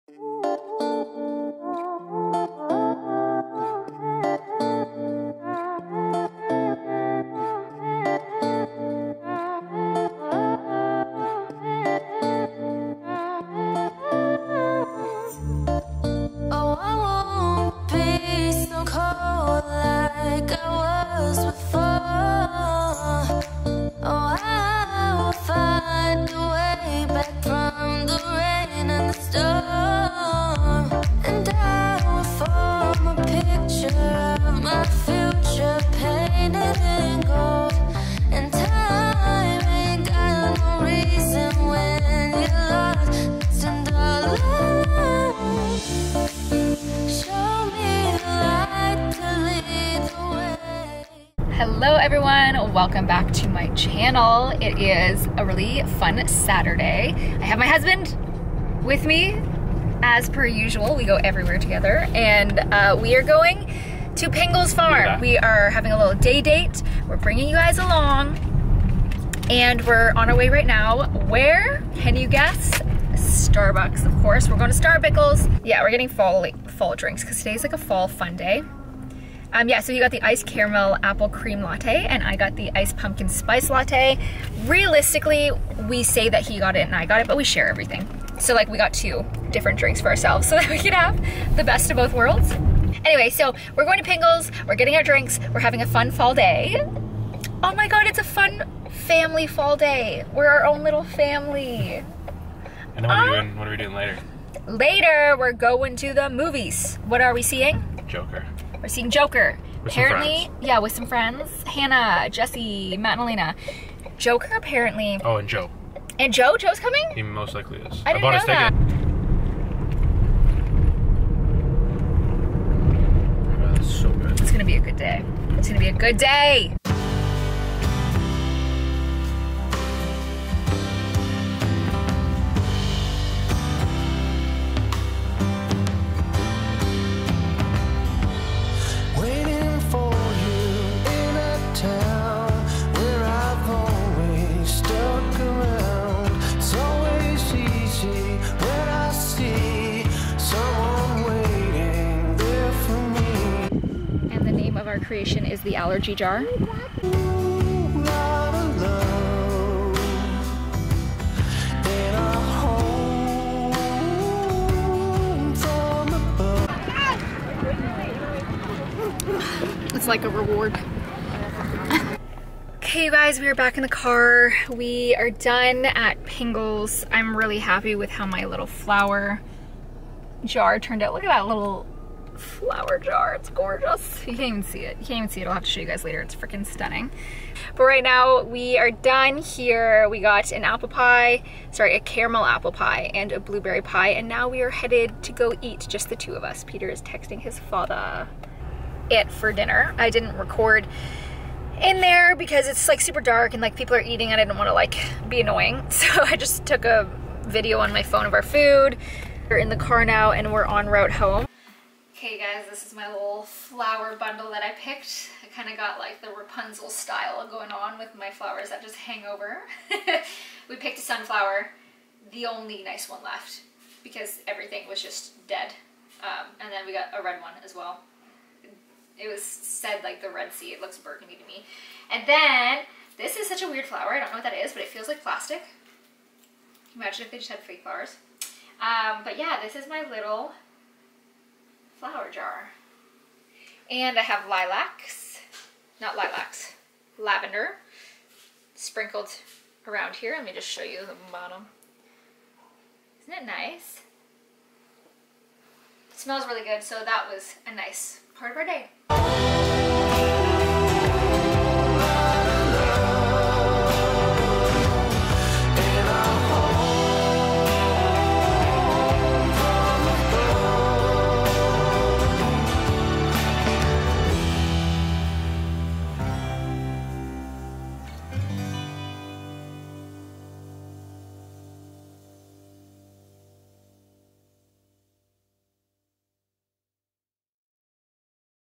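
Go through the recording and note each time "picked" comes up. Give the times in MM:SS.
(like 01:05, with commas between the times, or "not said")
03:34, 03:40.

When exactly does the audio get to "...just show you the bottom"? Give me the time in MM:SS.
04:10.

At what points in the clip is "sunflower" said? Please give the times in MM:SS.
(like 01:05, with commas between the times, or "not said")
03:41.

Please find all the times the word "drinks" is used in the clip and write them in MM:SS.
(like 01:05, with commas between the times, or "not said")
01:16, 01:29, 01:35.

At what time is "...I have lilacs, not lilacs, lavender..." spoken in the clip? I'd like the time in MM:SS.
04:04.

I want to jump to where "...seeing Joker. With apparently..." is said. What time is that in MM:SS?
01:48.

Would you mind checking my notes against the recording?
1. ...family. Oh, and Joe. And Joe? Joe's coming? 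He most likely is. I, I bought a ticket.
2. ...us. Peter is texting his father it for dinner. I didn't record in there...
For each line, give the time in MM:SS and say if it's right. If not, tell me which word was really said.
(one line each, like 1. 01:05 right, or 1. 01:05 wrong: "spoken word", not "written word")
1. 01:54 wrong: "apparently", not "family"
2. 03:16 right.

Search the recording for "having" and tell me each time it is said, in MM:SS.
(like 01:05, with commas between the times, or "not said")
01:05, 01:35.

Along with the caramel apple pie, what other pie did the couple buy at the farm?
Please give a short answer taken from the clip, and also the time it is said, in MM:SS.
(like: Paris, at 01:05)
Blueberry, at 03:13.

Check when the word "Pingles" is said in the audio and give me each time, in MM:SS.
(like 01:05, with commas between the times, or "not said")
01:04, 01:34, 02:56.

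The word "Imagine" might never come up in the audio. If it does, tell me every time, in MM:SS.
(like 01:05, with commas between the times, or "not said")
03:56.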